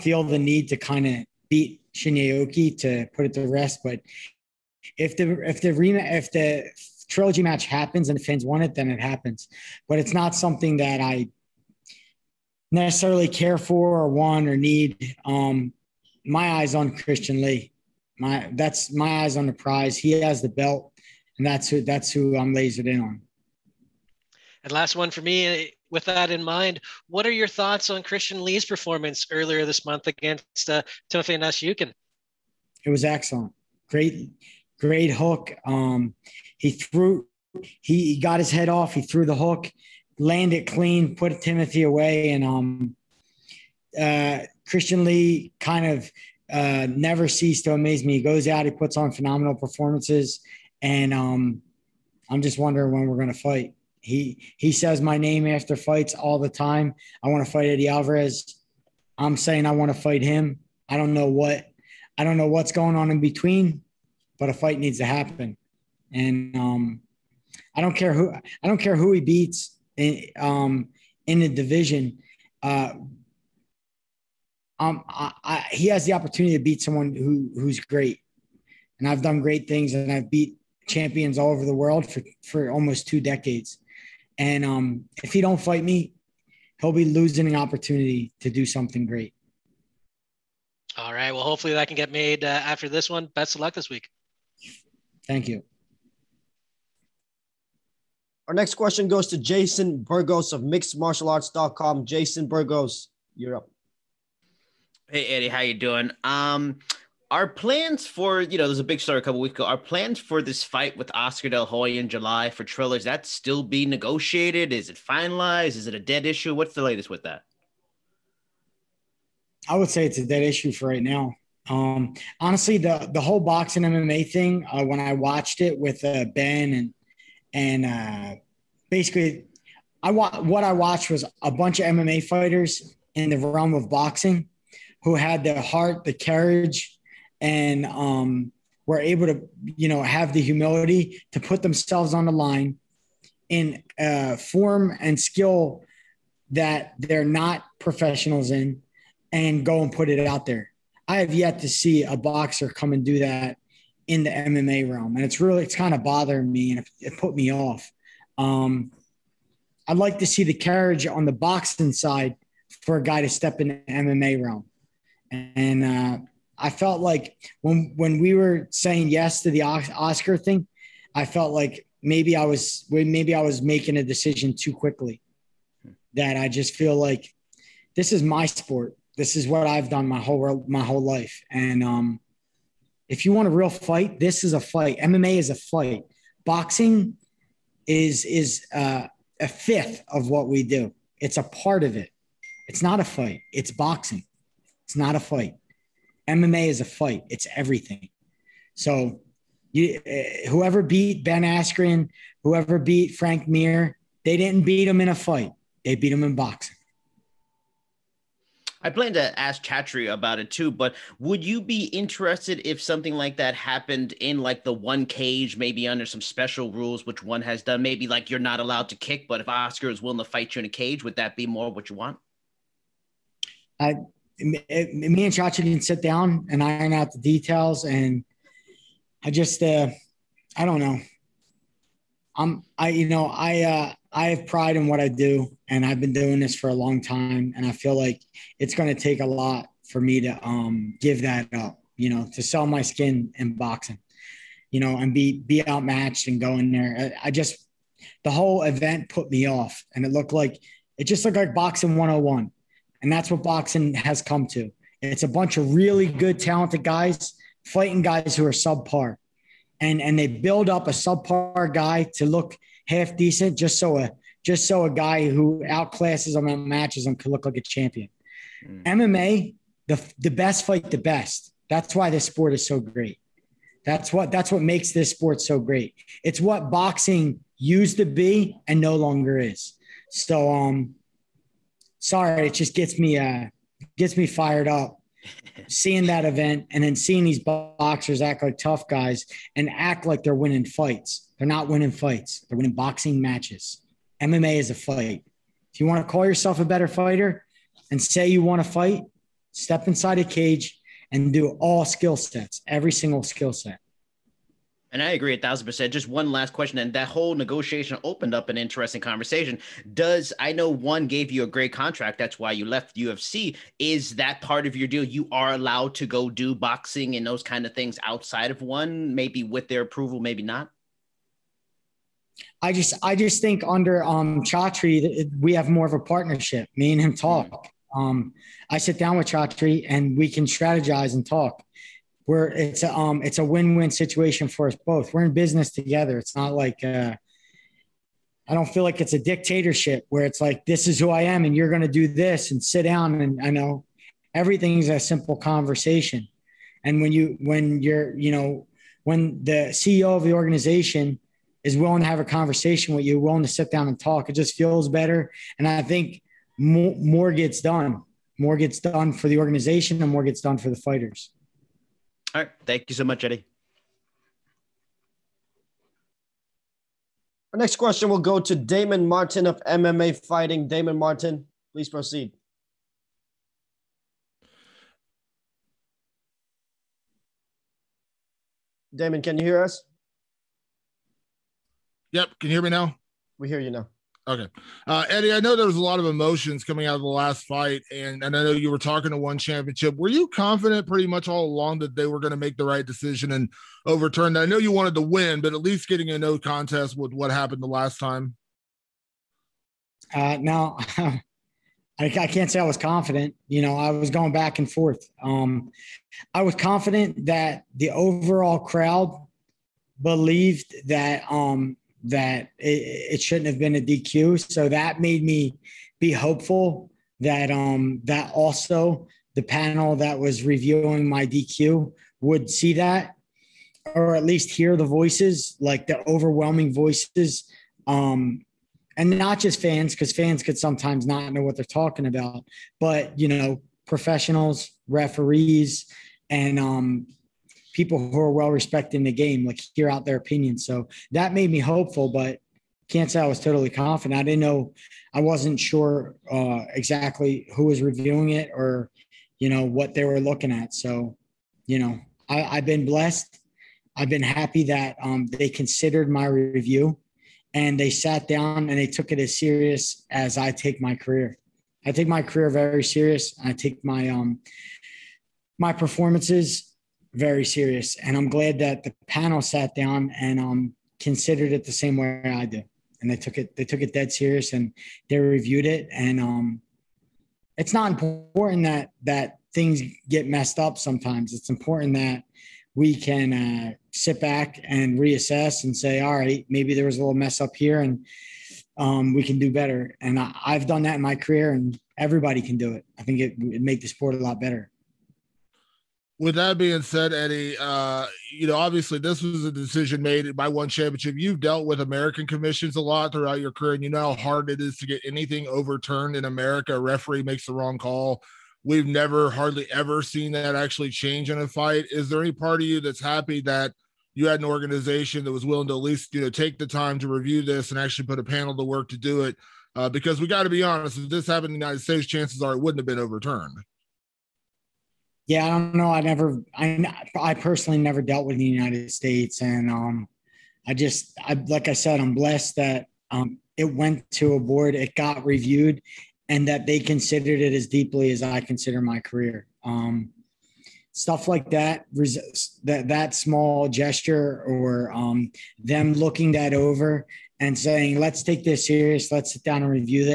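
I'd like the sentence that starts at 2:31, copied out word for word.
I have yet to see a boxer come and do that in the MMA realm.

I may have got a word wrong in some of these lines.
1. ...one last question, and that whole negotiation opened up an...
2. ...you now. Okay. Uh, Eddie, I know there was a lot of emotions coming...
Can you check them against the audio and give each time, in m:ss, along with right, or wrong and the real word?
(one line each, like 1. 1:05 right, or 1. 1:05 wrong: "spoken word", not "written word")
1. 5:06 right
2. 6:23 right.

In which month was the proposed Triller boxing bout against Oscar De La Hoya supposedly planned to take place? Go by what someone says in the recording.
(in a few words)
July.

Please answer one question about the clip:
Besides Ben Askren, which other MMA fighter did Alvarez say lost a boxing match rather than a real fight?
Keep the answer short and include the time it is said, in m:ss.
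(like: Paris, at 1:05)
Frank Mir, at 3:23.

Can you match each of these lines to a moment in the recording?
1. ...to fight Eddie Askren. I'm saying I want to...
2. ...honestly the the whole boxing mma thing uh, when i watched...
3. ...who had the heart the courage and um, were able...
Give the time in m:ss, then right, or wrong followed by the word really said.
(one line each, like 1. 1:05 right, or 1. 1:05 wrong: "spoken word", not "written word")
1. 0:57 wrong: "Alvarez", not "Askren"
2. 2:02 right
3. 2:15 right.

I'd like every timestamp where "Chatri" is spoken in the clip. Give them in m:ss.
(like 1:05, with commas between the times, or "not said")
3:29, 3:45, 5:24, 5:29.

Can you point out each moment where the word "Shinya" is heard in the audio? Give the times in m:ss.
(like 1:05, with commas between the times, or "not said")
0:01.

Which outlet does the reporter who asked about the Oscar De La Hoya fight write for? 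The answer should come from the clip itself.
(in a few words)
mixedmartialarts.com.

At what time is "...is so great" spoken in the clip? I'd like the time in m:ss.
4:32.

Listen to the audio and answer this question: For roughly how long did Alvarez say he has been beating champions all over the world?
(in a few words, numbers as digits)
Almost two decades.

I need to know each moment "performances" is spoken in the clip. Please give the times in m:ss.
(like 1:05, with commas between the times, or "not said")
0:28, 0:49, 7:45.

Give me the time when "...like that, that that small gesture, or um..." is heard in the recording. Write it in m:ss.
9:01.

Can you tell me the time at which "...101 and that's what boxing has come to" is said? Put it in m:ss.
4:11.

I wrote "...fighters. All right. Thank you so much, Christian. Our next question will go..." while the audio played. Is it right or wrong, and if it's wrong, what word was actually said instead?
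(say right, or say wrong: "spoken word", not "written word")
wrong: "Eddie", not "Christian".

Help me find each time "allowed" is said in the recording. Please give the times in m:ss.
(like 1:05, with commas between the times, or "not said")
3:38, 5:15.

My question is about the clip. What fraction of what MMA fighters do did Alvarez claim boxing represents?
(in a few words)
A fifth.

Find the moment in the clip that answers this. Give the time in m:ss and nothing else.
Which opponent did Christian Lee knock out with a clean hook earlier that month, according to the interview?
0:31.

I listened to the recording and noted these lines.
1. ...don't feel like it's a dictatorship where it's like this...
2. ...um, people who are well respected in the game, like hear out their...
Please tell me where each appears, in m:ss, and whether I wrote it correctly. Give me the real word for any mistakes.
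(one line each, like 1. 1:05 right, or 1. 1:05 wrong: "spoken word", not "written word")
1. 5:38 right
2. 7:16 right.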